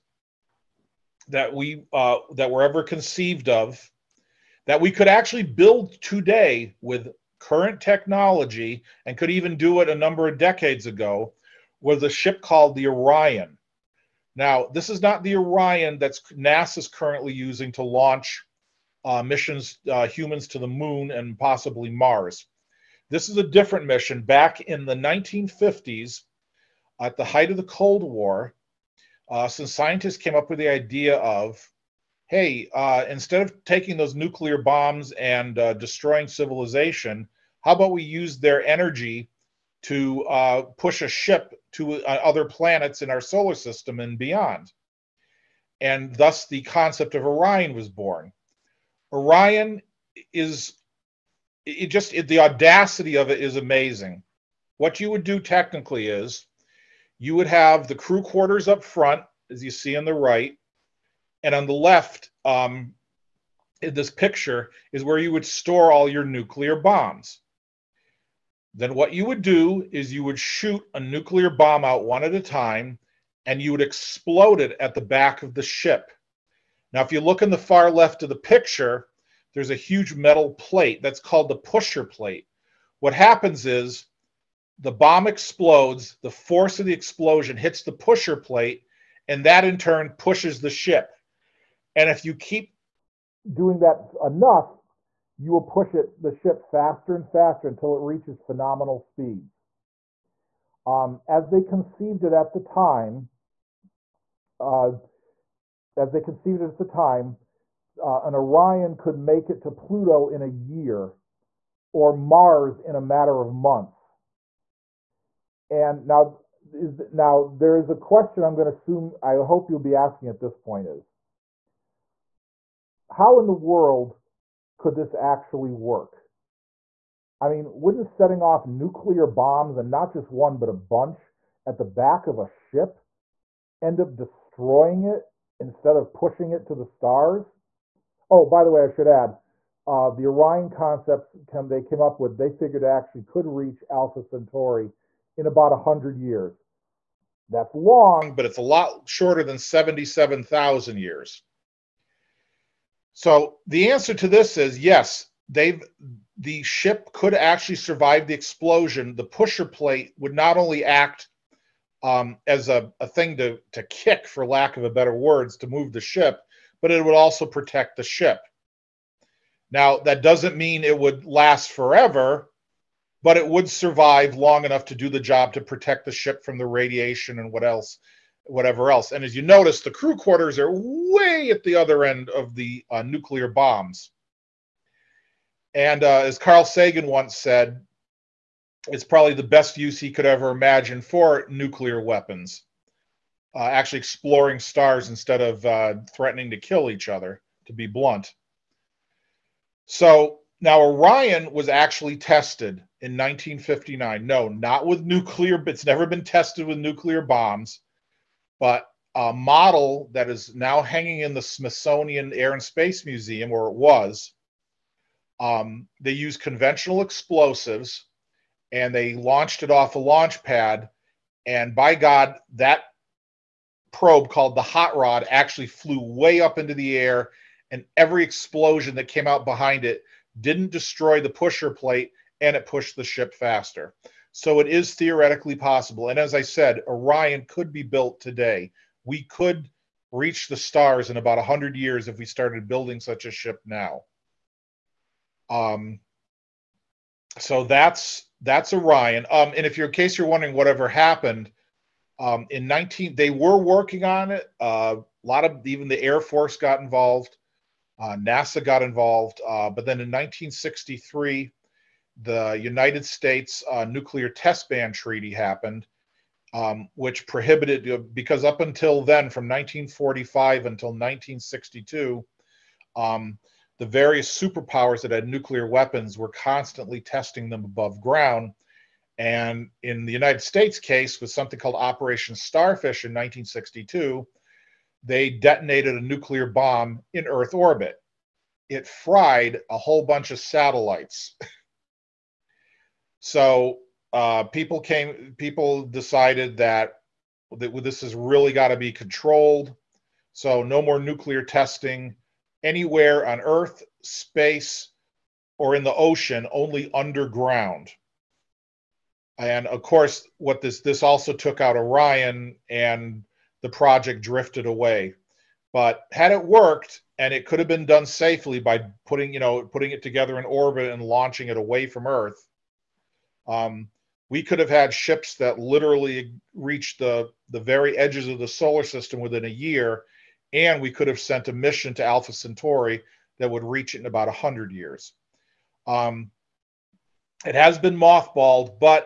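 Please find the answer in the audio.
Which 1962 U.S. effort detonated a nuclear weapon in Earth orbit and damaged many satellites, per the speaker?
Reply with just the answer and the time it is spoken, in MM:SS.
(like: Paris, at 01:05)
Operation Starfish, at 04:41.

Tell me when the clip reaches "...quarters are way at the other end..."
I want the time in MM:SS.
03:00.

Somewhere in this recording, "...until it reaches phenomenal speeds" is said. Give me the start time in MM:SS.
01:37.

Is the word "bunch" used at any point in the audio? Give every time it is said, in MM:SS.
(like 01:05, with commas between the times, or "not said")
02:10, 04:50.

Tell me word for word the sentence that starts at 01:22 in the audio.
What happens is the bomb explodes, the force of the explosion hits the pusher plate, and that in turn pushes the ship.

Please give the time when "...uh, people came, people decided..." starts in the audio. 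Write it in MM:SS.
04:54.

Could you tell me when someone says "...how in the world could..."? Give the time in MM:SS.
02:03.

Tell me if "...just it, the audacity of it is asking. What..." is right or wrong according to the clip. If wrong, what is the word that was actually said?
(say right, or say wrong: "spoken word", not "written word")
wrong: "amazing", not "asking".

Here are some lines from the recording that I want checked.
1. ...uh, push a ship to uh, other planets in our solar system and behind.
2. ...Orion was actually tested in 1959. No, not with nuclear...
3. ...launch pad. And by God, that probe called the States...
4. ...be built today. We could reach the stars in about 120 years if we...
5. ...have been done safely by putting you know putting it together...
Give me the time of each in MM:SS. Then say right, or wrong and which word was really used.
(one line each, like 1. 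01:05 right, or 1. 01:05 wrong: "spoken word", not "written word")
1. 00:40 wrong: "beyond", not "behind"
2. 03:20 right
3. 03:39 wrong: "Hot", not "States"
4. 03:57 wrong: "100", not "120"
5. 05:17 right.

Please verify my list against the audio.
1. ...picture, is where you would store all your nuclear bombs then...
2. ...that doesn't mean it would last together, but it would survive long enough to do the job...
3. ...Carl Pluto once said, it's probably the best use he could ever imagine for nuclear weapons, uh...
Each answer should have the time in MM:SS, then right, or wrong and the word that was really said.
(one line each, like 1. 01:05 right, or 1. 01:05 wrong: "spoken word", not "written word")
1. 01:04 right
2. 02:49 wrong: "forever", not "together"
3. 03:06 wrong: "Sagan", not "Pluto".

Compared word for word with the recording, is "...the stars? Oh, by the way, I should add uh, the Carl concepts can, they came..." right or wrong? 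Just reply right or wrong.
wrong.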